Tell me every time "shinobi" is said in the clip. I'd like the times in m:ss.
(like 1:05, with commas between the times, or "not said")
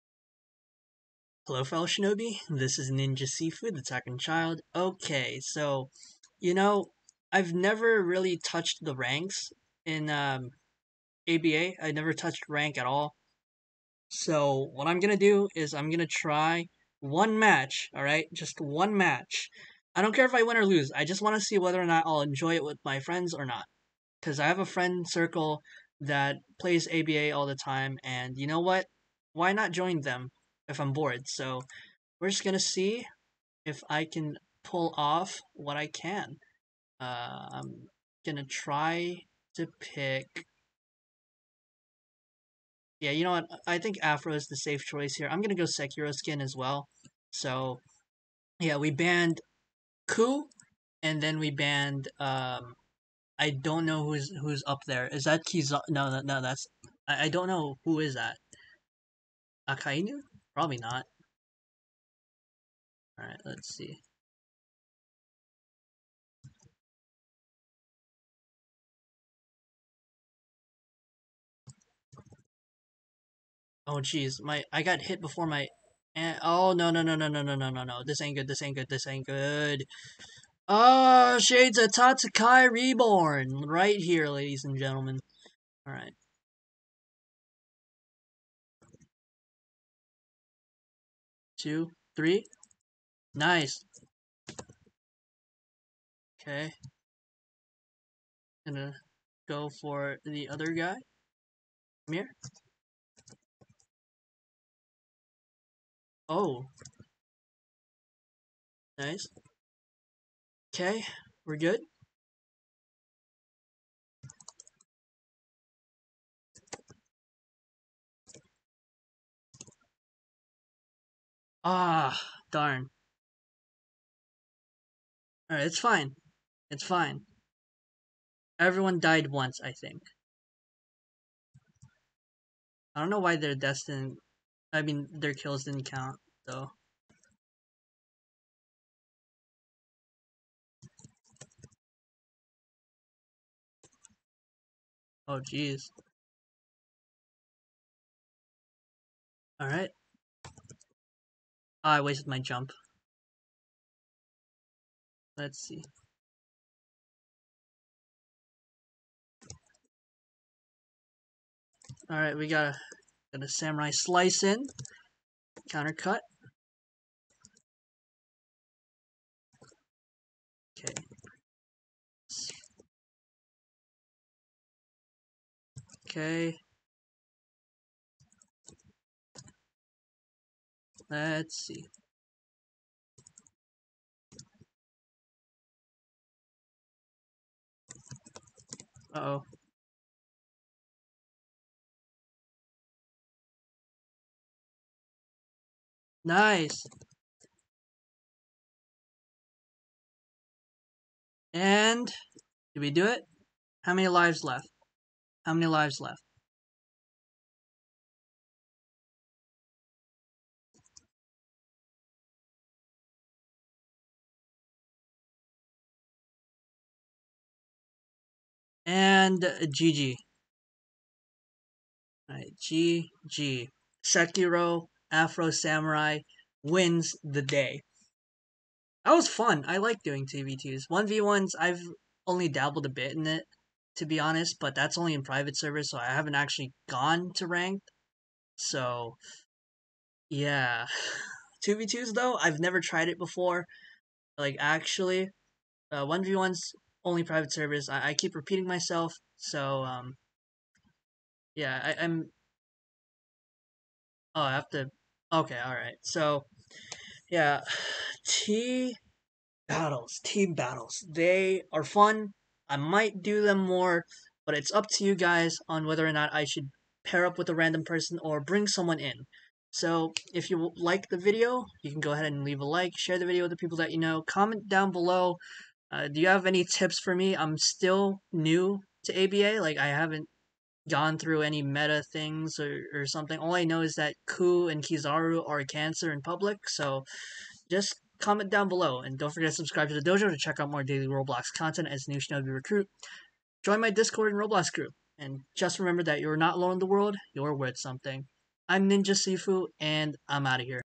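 0:01, 4:52.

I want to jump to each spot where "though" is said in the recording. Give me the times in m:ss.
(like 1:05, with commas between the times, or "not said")
2:16, 4:02.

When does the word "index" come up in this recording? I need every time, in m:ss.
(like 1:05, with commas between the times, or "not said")
not said.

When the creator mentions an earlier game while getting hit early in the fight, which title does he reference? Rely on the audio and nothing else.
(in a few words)
Tatsukai Reborn.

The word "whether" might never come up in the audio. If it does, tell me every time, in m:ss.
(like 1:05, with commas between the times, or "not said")
0:21, 4:25.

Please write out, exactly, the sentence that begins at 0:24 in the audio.
Because I have a friend circle that plays ABA all the time, and you know what?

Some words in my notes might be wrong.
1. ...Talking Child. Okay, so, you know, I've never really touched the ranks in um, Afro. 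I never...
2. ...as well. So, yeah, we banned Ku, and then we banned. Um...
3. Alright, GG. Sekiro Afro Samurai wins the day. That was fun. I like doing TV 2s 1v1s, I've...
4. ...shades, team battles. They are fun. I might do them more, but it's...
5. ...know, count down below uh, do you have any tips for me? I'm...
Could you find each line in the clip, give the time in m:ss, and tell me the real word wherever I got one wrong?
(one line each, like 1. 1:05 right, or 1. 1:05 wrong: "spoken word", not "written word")
1. 0:03 wrong: "ABA", not "Afro"
2. 0:46 right
3. 3:42 right
4. 4:19 wrong: "battles", not "shades"
5. 4:33 wrong: "comment", not "count".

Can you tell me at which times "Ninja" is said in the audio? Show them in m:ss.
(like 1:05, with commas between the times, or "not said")
0:02, 4:58.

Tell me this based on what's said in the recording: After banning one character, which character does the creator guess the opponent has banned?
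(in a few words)
Akainu.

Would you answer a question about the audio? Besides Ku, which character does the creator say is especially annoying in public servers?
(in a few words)
Kizaru.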